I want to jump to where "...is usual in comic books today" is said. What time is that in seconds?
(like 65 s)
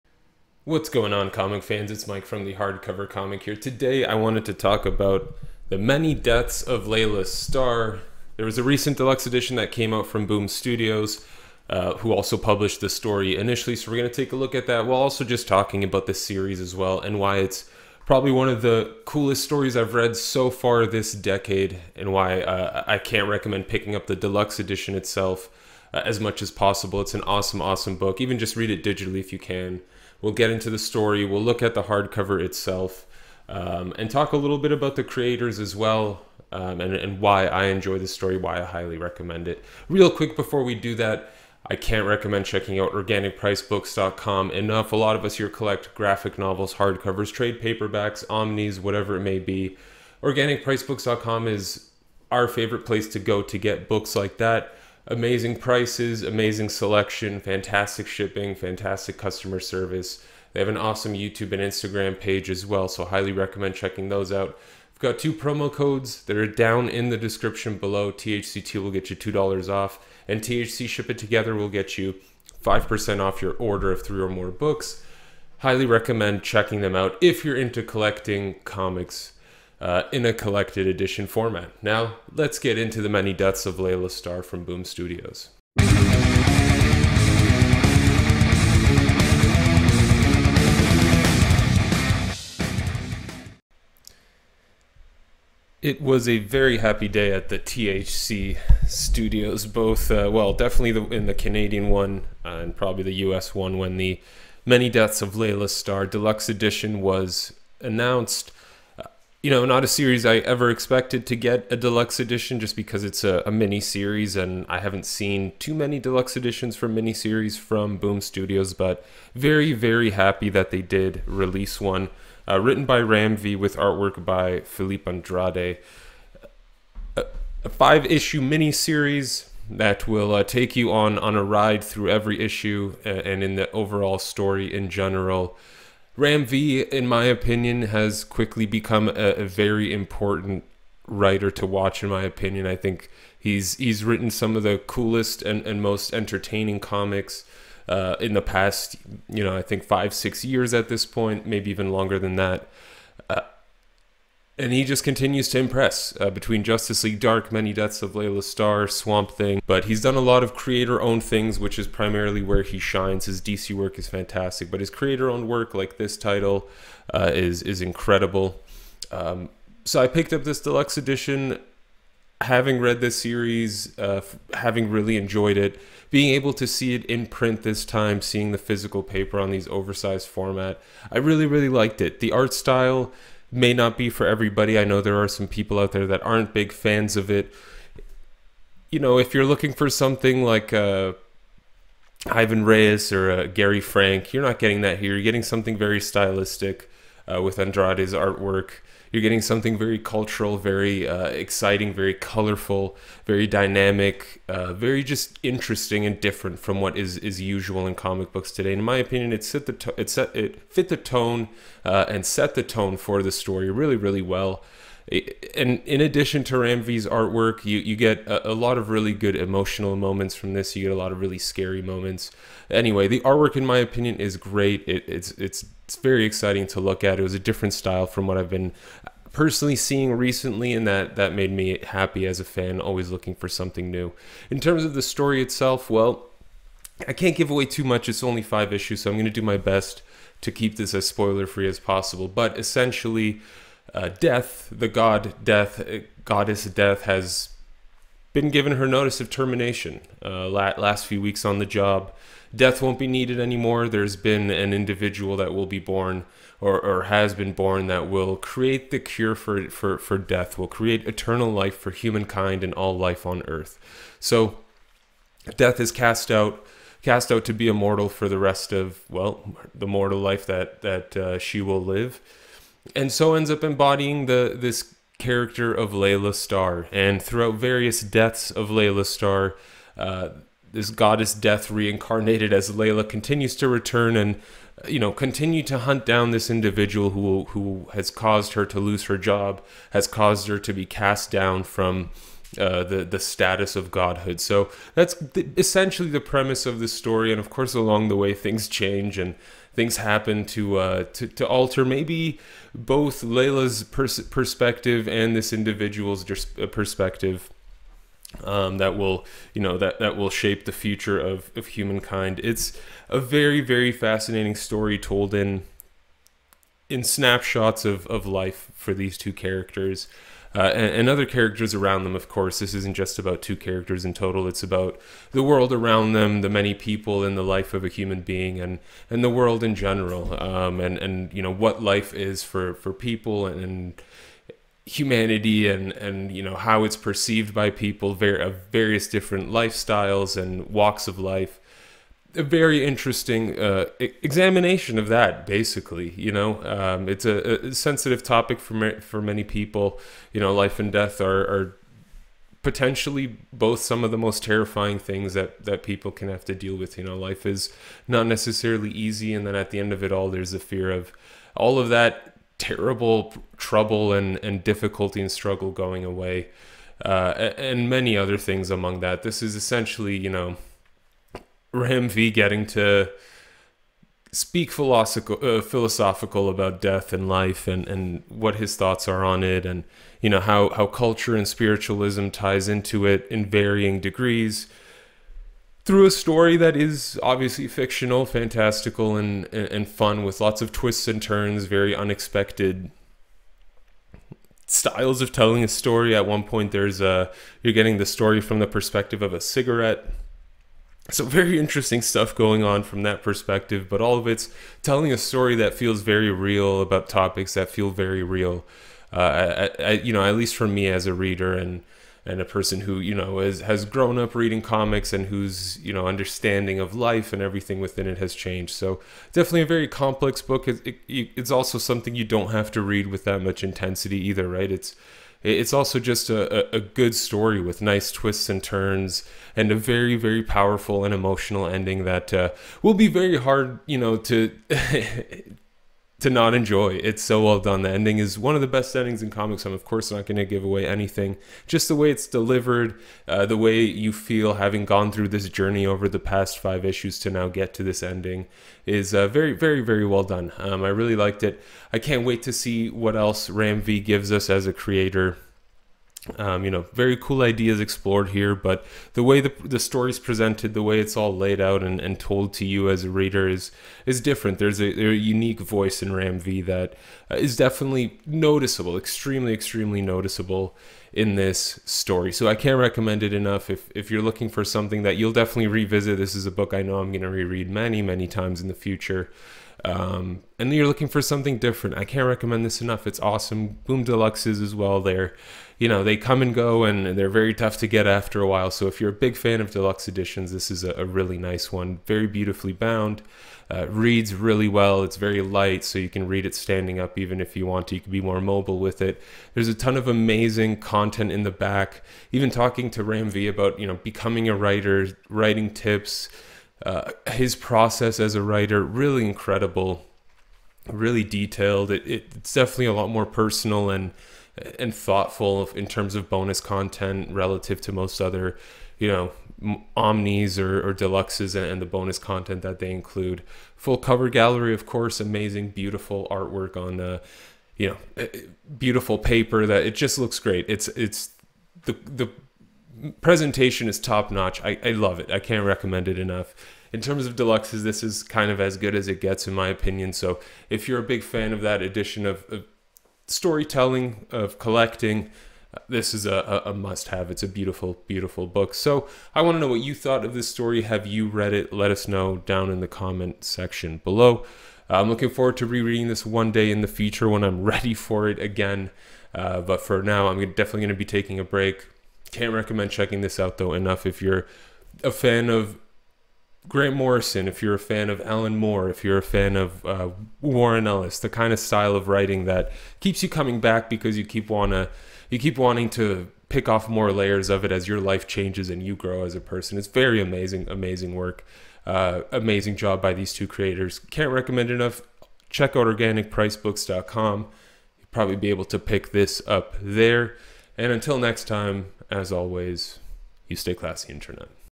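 207 s.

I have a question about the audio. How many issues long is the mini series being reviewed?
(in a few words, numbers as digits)
5.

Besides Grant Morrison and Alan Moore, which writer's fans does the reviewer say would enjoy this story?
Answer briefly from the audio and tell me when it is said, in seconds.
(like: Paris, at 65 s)
Warren Ellis, at 570 s.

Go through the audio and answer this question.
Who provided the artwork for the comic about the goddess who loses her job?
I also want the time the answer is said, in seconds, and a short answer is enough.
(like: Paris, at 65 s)
Philippe Andrade, at 124 s.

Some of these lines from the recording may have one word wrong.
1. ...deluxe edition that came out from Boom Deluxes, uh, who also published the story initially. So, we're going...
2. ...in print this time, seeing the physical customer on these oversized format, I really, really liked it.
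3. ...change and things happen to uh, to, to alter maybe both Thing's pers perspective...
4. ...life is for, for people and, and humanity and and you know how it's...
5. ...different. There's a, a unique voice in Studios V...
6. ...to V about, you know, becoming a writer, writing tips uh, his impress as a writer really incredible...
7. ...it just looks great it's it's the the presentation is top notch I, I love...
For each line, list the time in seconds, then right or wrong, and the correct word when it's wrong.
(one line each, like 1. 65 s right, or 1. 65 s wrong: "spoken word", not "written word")
1. 8 s wrong: "Studios", not "Deluxes"
2. 177 s wrong: "paper", not "customer"
3. 298 s wrong: "Laila", not "Thing"
4. 331 s right
5. 464 s wrong: "Ram", not "Studios"
6. 502 s wrong: "process", not "impress"
7. 529 s right.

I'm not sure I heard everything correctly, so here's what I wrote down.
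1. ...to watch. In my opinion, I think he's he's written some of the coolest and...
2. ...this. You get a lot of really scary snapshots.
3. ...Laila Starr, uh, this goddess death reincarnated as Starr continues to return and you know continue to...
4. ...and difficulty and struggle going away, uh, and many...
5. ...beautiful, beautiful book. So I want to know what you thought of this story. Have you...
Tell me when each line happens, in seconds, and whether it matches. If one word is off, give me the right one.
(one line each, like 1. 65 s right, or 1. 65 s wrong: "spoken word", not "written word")
1. 141 s right
2. 220 s wrong: "moments", not "snapshots"
3. 278 s wrong: "Laila", not "Starr"
4. 364 s right
5. 547 s right.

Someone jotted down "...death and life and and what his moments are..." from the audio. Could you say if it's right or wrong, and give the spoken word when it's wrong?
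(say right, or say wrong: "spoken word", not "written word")
wrong: "thoughts", not "moments".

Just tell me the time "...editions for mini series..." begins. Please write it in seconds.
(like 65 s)
116 s.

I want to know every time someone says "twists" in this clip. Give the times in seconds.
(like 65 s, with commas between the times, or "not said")
390 s, 428 s.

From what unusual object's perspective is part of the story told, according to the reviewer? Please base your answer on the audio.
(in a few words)
A cigarette.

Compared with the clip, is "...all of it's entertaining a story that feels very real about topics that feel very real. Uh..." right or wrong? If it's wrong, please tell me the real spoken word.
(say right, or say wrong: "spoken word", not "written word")
wrong: "telling", not "entertaining".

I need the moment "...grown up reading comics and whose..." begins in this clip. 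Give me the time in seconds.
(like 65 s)
413 s.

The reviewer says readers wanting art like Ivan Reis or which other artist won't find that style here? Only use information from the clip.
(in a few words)
Gary Frank.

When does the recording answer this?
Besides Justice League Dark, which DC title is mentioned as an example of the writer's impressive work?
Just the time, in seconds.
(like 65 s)
158 s.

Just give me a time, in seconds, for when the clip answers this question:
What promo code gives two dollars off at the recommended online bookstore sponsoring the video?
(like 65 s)
68 s.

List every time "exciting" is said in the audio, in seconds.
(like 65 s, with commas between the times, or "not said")
201 s, 226 s.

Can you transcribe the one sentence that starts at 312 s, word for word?
It's a very very fascinating story told in in snapshots of of life for these two characters.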